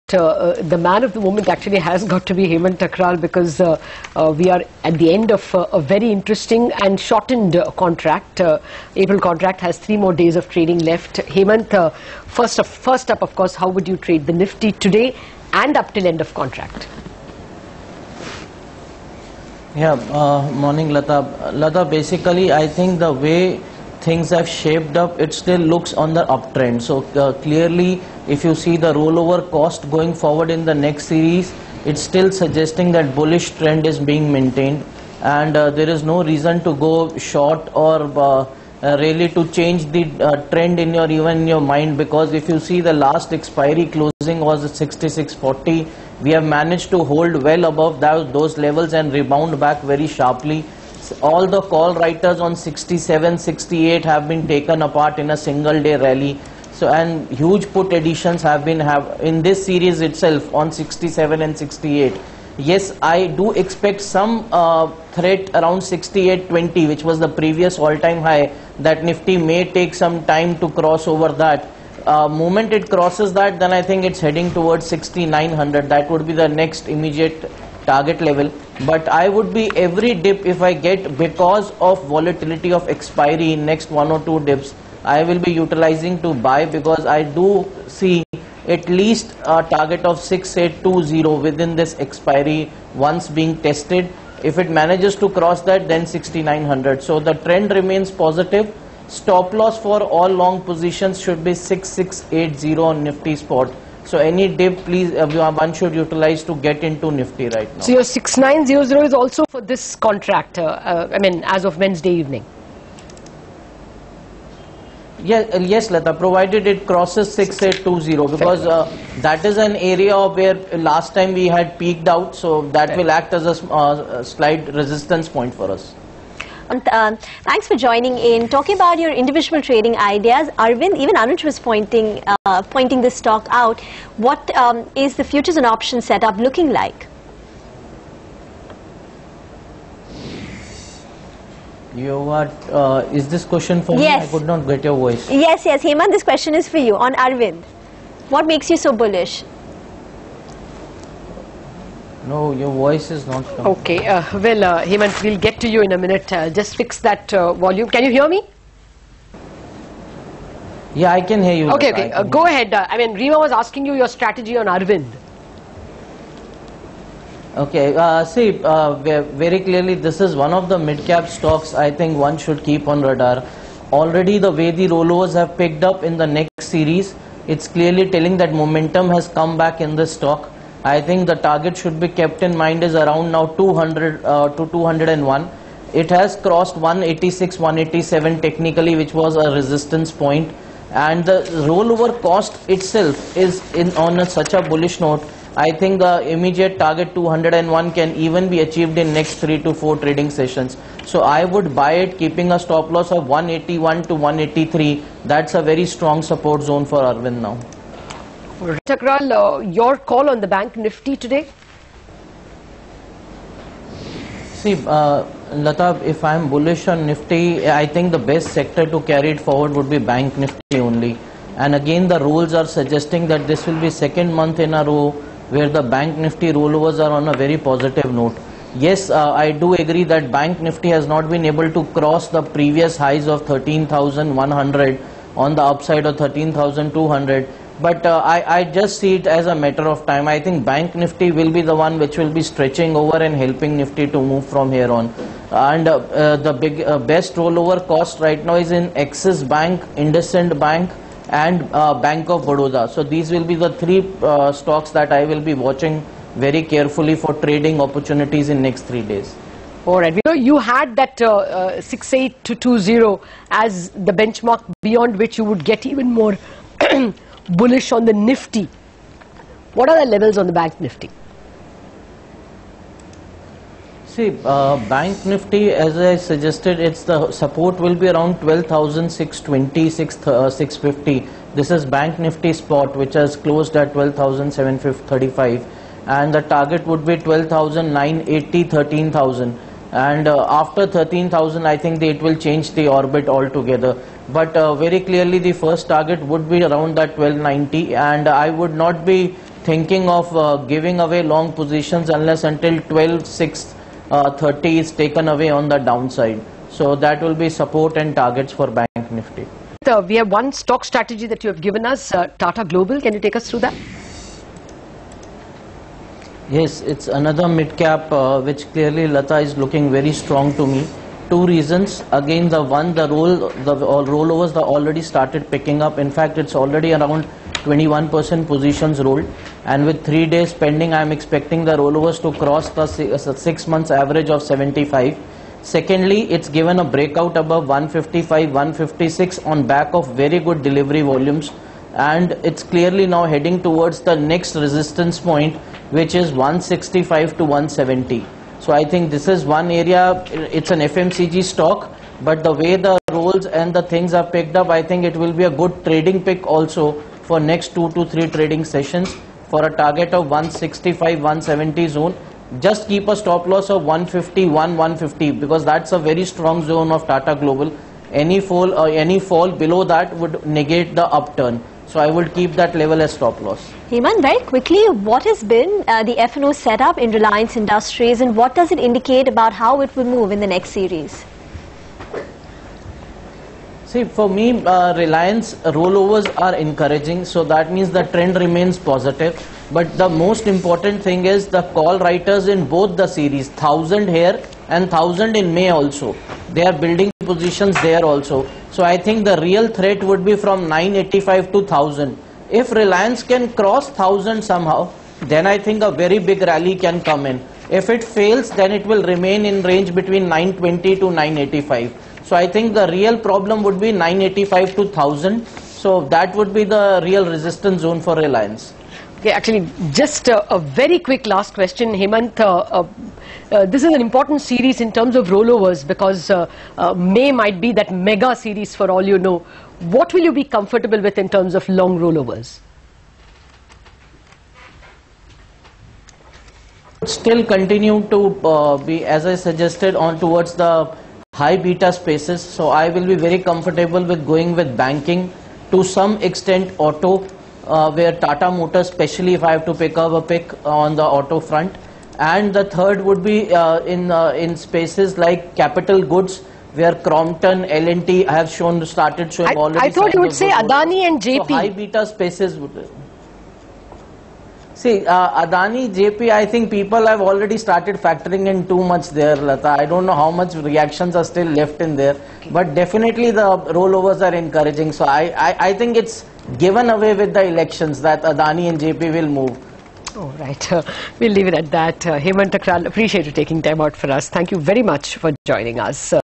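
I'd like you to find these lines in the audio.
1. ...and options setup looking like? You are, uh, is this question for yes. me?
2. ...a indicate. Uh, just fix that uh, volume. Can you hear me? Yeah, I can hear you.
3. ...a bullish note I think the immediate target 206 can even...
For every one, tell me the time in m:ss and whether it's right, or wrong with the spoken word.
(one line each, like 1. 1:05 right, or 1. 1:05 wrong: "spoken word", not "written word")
1. 2:15 right
2. 2:35 wrong: "minute", not "indicate"
3. 3:14 wrong: "201", not "206".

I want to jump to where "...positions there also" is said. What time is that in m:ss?
6:37.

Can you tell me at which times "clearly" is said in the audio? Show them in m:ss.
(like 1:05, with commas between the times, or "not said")
0:27, 2:49, 2:57, 4:55, 5:18, 5:42.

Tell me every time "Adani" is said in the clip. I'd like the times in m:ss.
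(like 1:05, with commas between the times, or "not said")
7:40, 7:45, 7:58.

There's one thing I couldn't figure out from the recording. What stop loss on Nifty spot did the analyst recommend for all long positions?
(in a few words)
6680.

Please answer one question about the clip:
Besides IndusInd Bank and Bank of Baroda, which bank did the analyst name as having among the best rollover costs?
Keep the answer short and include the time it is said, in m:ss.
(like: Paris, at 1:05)
Axis Bank, at 4:08.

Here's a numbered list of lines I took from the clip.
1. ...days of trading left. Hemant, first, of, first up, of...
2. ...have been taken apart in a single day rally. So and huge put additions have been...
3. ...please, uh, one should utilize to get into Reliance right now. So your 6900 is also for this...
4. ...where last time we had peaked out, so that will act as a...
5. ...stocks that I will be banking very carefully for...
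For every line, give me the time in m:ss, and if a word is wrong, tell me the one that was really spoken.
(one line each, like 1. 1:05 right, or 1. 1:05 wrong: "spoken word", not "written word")
1. 0:10 right
2. 0:54 right
3. 1:44 wrong: "Nifty", not "Reliance"
4. 2:00 right
5. 4:14 wrong: "watching", not "banking".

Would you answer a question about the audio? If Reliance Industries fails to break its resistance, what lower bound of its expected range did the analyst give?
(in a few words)
920.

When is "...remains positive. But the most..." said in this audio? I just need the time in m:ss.
6:28.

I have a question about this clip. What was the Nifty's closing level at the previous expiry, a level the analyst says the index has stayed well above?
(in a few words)
66.40.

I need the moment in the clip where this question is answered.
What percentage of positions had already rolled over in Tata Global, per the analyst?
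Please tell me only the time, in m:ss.
5:27.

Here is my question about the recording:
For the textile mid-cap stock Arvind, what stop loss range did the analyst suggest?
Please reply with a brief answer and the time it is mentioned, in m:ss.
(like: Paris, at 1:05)
181 to 183, at 3:23.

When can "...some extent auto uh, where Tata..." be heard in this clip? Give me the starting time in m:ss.
7:25.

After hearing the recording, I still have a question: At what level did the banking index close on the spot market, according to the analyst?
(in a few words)
12,735.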